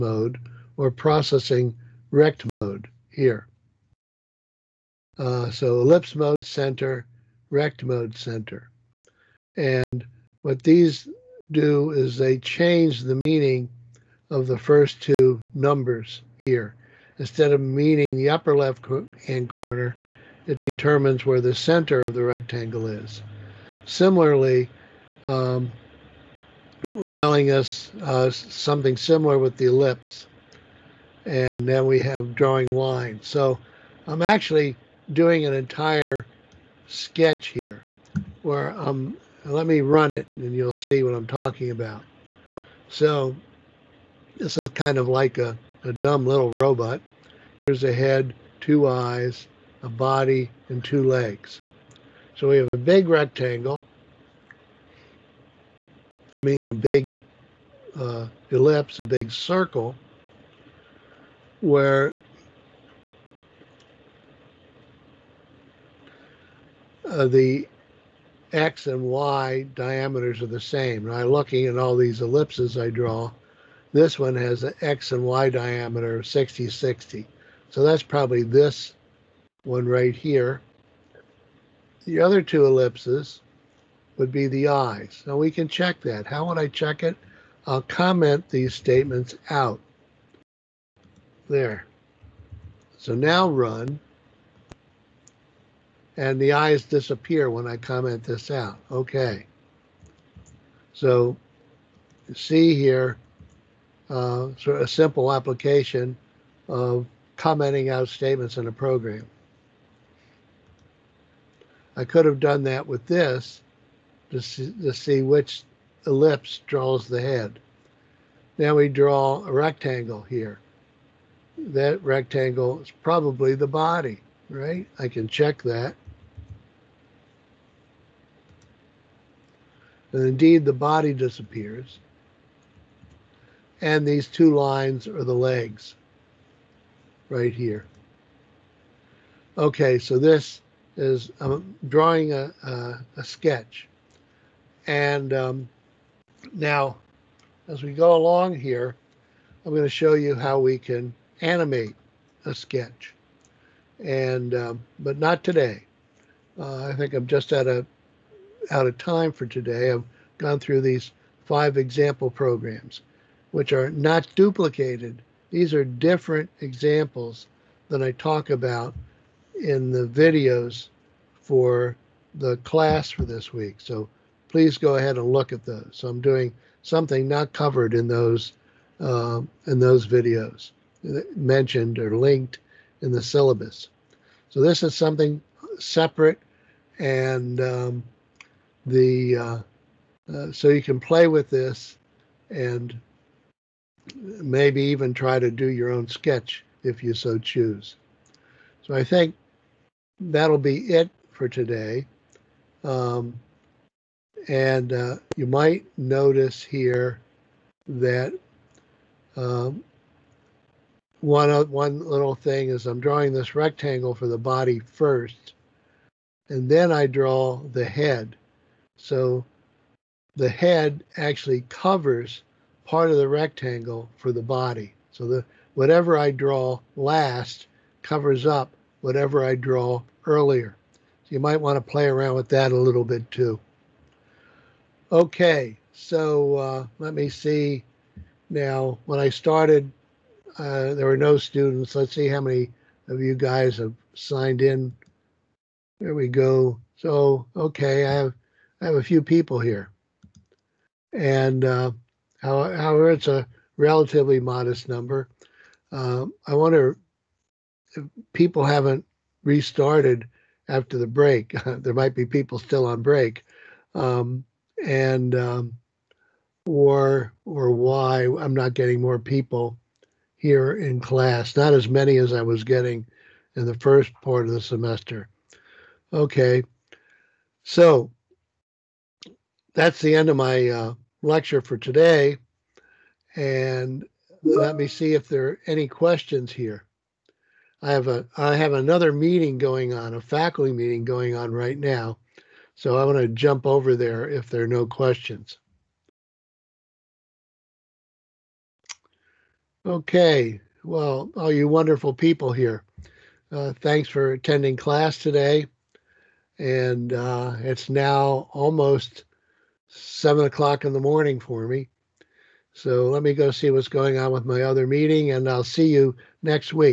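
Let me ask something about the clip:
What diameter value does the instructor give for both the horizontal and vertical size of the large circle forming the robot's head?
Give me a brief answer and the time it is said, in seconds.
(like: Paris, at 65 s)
60, at 76 s.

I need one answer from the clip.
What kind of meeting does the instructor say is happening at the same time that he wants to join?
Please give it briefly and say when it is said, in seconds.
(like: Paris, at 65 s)
faculty meeting, at 290 s.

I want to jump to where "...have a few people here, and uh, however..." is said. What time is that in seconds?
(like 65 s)
248 s.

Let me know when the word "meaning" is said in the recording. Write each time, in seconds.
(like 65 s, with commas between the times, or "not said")
13 s, 17 s, 56 s.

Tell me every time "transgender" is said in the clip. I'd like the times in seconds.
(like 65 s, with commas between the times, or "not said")
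not said.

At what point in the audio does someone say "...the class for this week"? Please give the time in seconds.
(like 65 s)
172 s.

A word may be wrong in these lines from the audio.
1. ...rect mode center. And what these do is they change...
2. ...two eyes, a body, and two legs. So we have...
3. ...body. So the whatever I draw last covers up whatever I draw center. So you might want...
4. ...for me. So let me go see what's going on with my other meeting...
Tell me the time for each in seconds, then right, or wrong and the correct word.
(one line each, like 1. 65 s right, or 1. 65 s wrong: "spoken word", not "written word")
1. 7 s right
2. 48 s right
3. 224 s wrong: "earlier", not "center"
4. 311 s right.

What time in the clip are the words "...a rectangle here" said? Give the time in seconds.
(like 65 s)
119 s.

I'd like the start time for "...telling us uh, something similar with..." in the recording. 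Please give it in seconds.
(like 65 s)
27 s.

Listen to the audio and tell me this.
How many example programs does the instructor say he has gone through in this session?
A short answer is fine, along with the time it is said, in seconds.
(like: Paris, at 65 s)
5, at 161 s.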